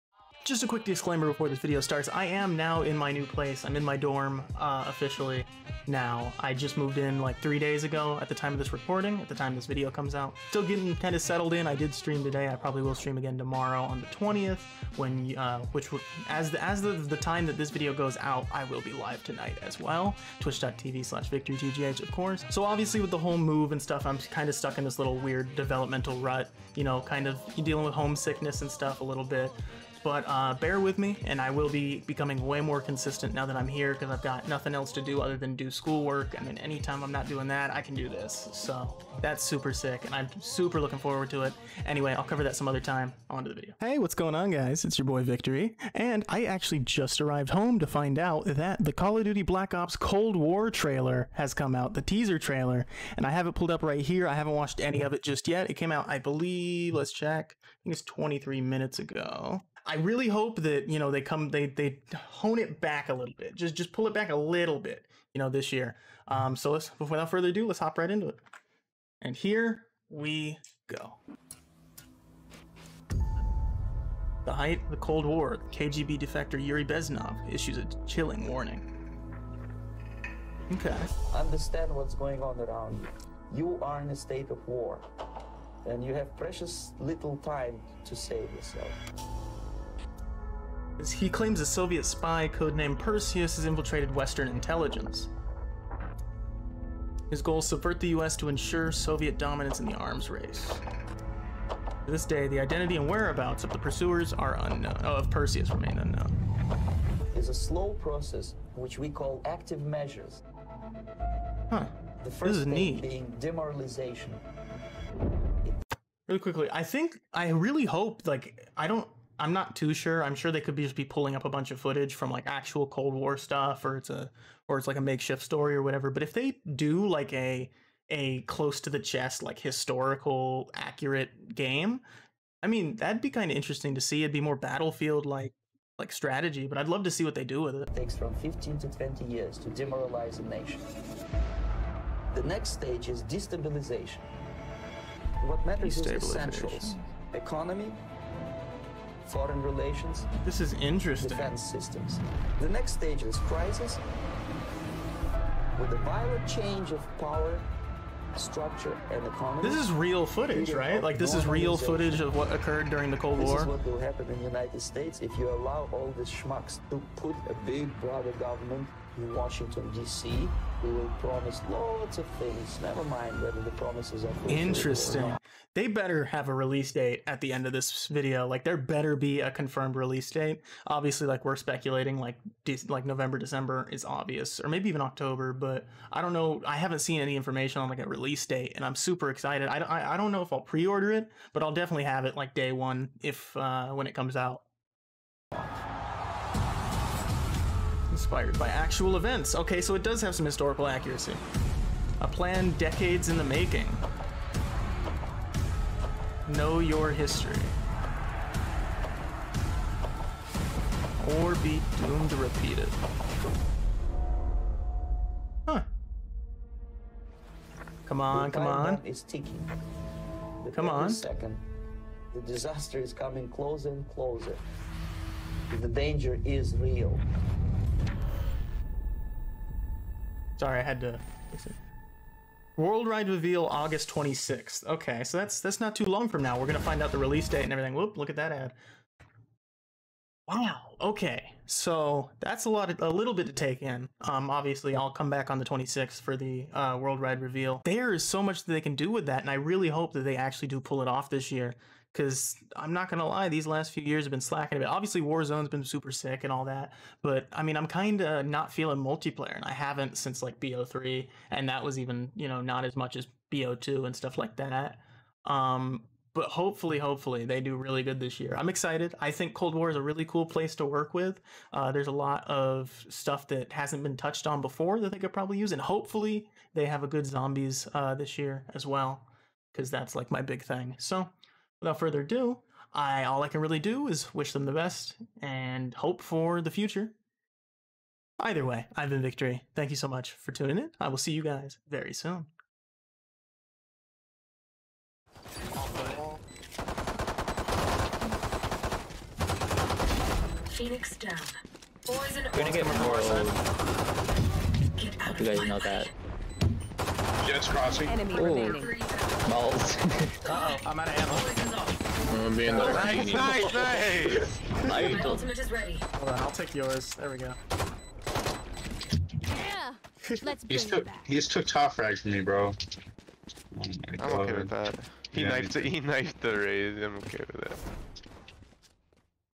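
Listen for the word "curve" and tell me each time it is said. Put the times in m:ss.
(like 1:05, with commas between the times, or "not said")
not said.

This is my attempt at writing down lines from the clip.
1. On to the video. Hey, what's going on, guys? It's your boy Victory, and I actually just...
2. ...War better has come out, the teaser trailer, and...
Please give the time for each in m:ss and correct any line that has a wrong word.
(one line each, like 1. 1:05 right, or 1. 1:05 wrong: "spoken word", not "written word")
1. 0:43 right
2. 0:50 wrong: "trailer", not "better".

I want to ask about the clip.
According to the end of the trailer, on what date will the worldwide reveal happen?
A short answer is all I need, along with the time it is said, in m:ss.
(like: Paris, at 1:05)
August 26th, at 3:53.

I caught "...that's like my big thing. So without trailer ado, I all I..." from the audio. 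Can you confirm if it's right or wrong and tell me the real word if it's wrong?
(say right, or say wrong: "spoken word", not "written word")
wrong: "further", not "trailer".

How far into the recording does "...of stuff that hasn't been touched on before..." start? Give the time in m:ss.
4:32.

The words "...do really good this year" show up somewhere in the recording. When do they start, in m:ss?
4:27.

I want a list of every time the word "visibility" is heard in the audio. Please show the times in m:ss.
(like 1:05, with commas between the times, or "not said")
not said.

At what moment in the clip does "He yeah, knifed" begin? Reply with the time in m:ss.
5:25.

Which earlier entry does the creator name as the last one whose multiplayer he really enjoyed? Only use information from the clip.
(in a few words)
BO3.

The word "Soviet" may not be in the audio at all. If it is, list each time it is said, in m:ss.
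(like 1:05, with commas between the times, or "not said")
1:31, 1:38.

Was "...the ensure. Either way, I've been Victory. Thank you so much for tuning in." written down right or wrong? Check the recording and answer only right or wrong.
wrong.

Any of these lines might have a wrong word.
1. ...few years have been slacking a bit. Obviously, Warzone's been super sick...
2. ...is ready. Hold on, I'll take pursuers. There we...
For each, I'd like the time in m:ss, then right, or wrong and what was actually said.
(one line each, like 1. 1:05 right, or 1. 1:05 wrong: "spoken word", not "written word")
1. 4:13 right
2. 5:15 wrong: "yours", not "pursuers".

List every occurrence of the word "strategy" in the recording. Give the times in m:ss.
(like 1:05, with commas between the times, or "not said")
2:16.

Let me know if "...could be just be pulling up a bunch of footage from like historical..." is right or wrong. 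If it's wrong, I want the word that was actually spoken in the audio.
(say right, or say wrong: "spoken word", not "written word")
wrong: "actual", not "historical".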